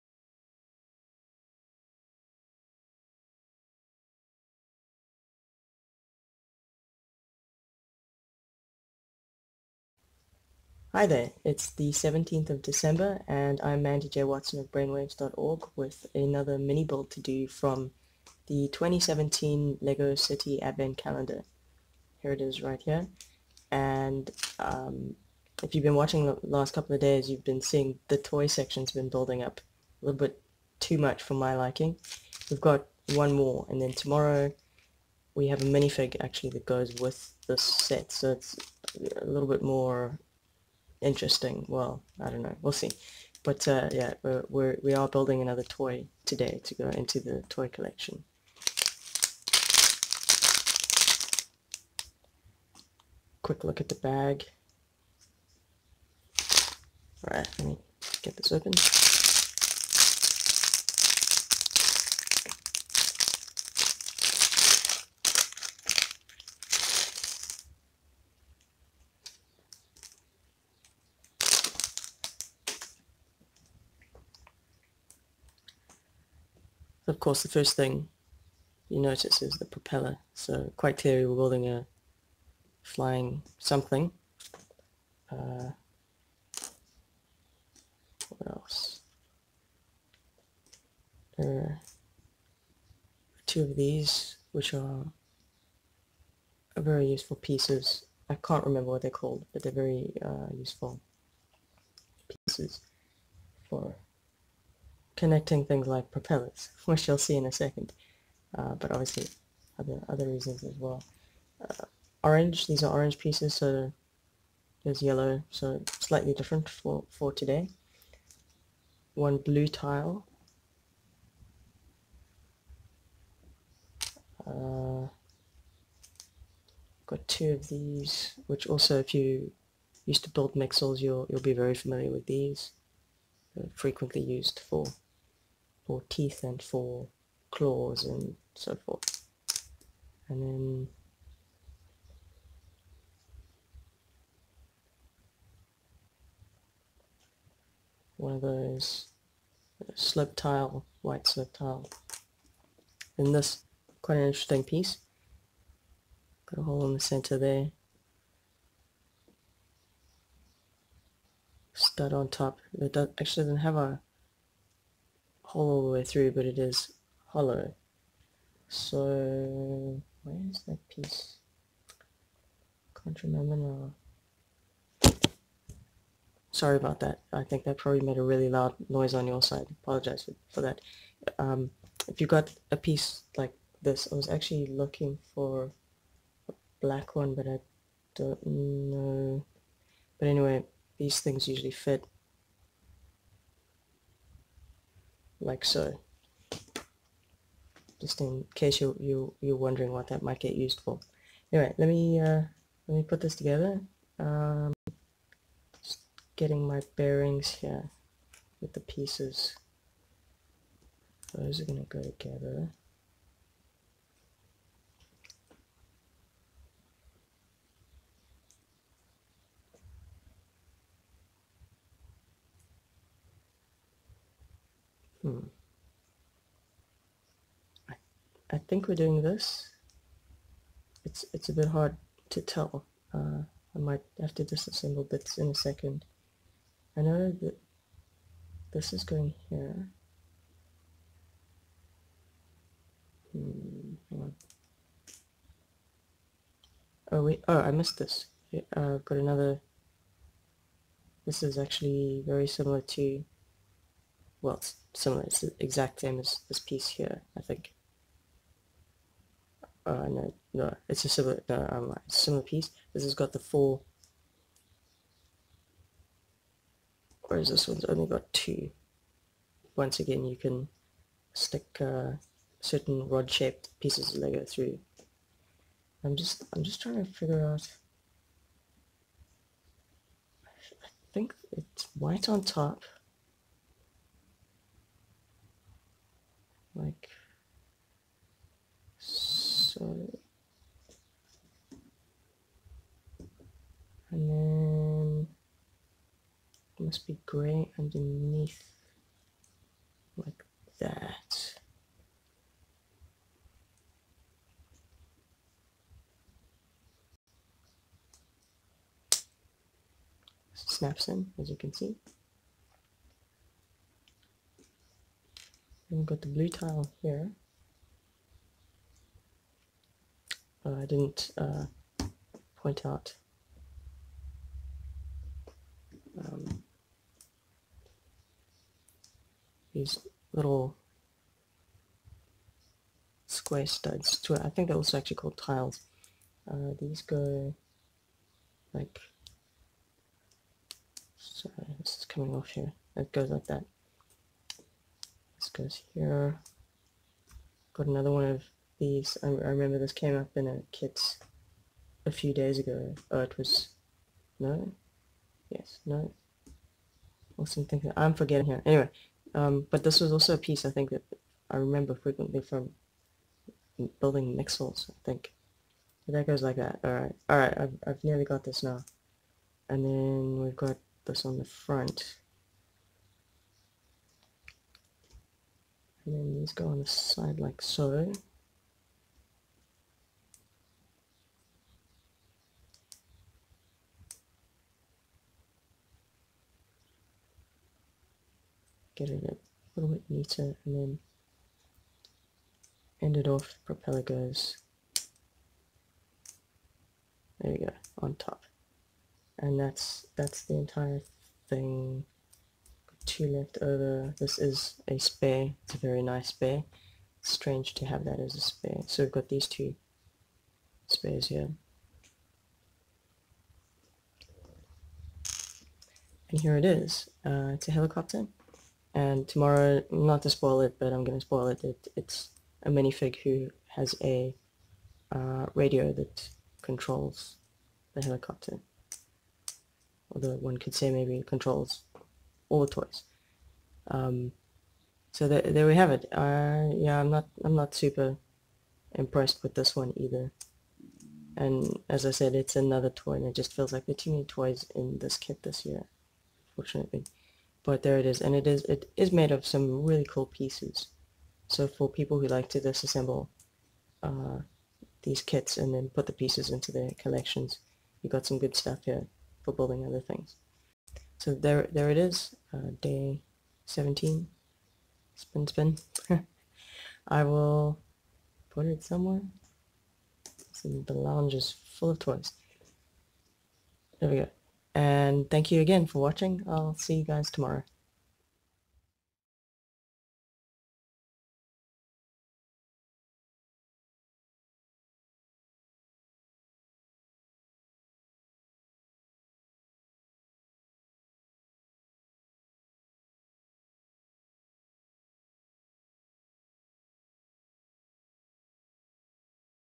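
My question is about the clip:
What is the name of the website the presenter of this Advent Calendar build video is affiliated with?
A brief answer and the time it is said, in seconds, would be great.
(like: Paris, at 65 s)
Brainwavez.org, at 14 s.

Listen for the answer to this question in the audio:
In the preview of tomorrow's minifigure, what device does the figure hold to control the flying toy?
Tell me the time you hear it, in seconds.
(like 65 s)
425 s.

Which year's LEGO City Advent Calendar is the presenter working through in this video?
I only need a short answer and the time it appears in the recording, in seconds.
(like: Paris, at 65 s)
2017, at 18 s.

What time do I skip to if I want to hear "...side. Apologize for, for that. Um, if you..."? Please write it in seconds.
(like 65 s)
179 s.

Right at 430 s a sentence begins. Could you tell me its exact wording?
Although one could say maybe it controls all the toys.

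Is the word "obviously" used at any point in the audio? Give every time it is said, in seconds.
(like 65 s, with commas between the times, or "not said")
108 s.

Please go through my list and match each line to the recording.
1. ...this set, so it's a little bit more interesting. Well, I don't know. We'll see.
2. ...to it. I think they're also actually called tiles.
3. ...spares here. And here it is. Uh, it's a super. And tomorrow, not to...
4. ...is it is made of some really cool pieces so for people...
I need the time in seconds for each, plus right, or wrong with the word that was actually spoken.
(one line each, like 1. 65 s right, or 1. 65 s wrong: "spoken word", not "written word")
1. 37 s right
2. 334 s right
3. 410 s wrong: "helicopter", not "super"
4. 448 s right.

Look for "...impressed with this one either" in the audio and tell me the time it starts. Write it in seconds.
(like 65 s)
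438 s.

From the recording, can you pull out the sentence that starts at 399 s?
And that's, that's the entire thing.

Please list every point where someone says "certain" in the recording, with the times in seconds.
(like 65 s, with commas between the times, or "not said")
272 s.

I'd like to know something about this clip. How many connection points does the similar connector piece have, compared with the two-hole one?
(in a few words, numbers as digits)
4.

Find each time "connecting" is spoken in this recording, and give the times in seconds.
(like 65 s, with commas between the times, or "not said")
105 s.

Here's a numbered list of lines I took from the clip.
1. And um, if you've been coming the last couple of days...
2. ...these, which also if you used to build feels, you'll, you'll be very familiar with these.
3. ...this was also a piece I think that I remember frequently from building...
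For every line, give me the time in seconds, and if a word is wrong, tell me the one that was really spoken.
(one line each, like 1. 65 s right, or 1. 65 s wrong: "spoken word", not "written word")
1. 23 s wrong: "watching", not "coming"
2. 127 s wrong: "mixels", not "feels"
3. 359 s right.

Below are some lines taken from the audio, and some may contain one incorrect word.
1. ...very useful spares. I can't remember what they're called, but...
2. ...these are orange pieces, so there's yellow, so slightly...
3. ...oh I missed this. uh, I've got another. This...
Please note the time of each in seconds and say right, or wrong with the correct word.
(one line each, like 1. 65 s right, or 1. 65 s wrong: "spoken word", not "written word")
1. 96 s wrong: "pieces", not "spares"
2. 112 s right
3. 247 s right.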